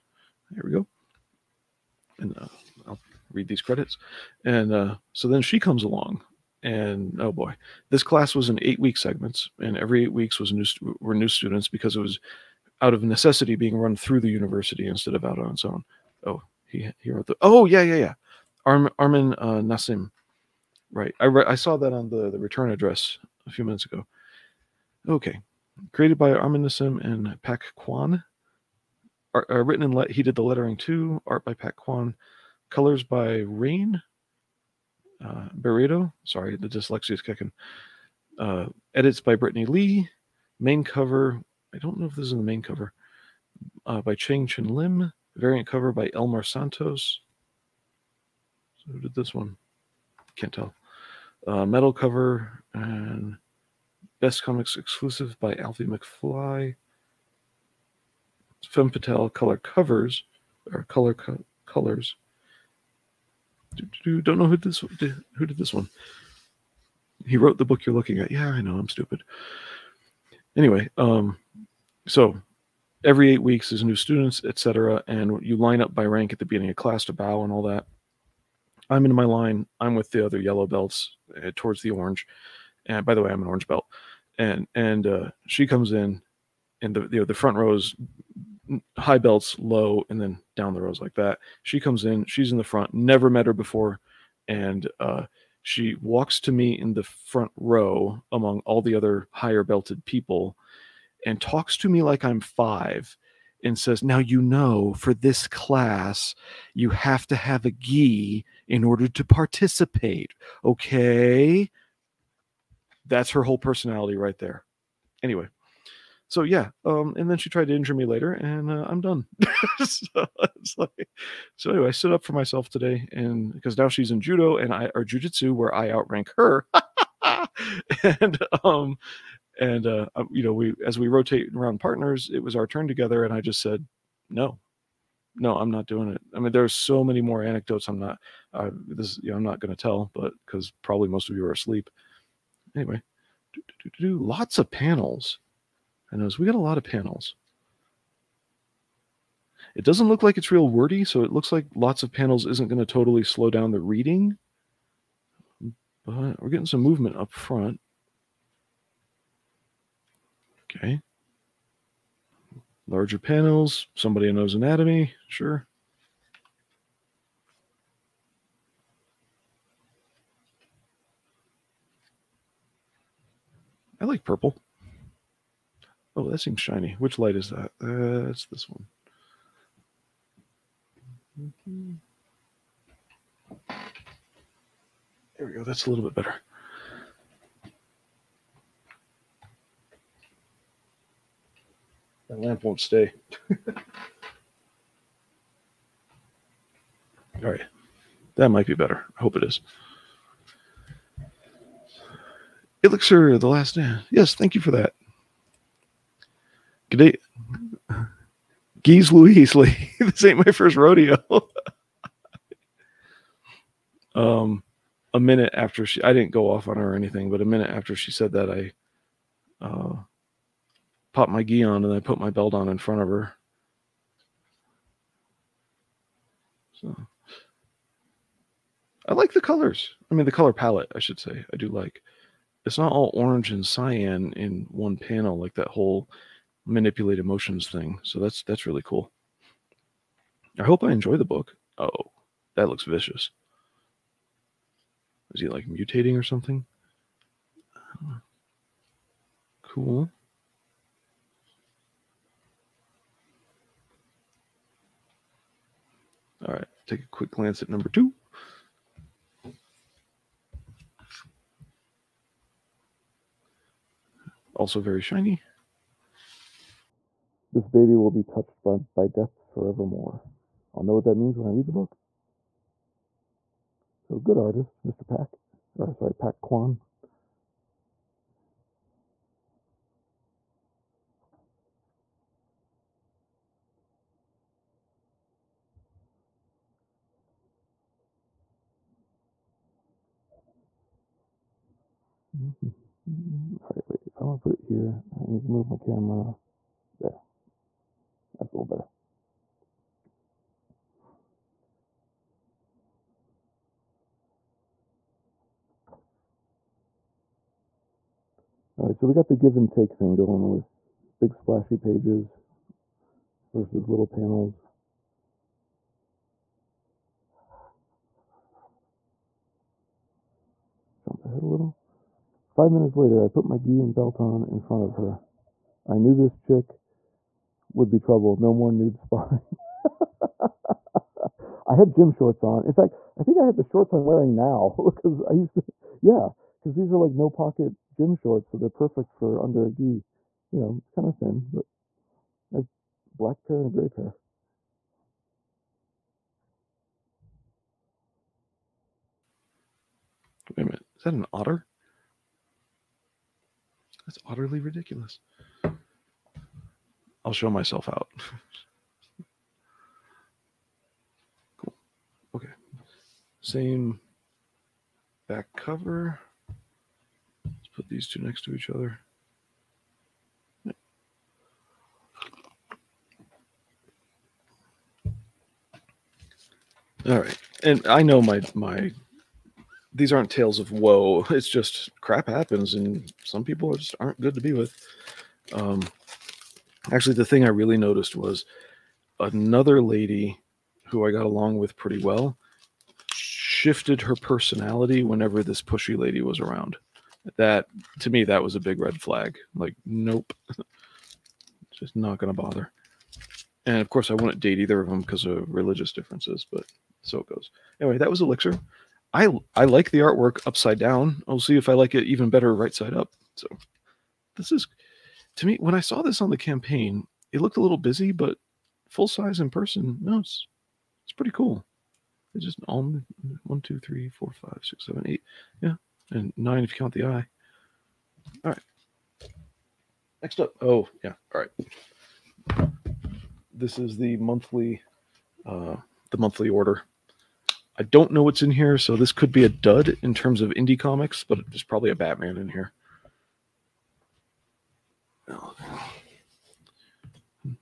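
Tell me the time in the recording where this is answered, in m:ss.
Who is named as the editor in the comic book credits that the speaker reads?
0:38.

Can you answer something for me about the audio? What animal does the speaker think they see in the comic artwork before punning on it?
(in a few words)
Otter.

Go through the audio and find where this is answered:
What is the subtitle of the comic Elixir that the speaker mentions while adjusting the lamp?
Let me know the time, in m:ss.
3:23.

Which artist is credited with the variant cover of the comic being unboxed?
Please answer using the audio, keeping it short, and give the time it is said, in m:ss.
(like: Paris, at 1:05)
Elmar Santos, at 0:45.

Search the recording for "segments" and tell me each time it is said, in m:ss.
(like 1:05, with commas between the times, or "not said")
0:08.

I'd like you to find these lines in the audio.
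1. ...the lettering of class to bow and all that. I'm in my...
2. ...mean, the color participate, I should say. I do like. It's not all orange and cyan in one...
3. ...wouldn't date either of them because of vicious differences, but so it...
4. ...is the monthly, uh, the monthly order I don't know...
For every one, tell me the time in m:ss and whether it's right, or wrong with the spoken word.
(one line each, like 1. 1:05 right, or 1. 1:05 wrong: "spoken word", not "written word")
1. 1:16 wrong: "beginning", not "lettering"
2. 3:50 wrong: "palette", not "participate"
3. 6:44 wrong: "religious", not "vicious"
4. 7:13 right.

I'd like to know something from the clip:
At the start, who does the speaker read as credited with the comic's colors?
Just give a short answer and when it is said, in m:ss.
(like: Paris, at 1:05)
Rain, at 0:32.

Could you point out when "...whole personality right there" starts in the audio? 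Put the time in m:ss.
1:53.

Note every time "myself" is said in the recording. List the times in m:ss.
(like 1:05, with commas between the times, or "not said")
2:02, 5:57.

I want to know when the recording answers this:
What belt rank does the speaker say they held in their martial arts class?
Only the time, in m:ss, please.
1:23.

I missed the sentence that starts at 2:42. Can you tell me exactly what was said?
Larger panels, somebody who knows anatomy, sure.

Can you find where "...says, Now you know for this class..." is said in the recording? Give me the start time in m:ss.
1:43.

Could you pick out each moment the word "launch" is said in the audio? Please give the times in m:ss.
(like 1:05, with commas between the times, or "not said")
not said.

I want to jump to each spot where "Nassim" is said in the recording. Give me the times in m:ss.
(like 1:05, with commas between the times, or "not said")
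0:19, 0:26.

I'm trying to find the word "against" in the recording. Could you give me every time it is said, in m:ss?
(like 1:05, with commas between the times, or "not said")
not said.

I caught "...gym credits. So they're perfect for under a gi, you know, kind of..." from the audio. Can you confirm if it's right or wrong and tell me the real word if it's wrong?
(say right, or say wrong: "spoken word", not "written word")
wrong: "shorts", not "credits".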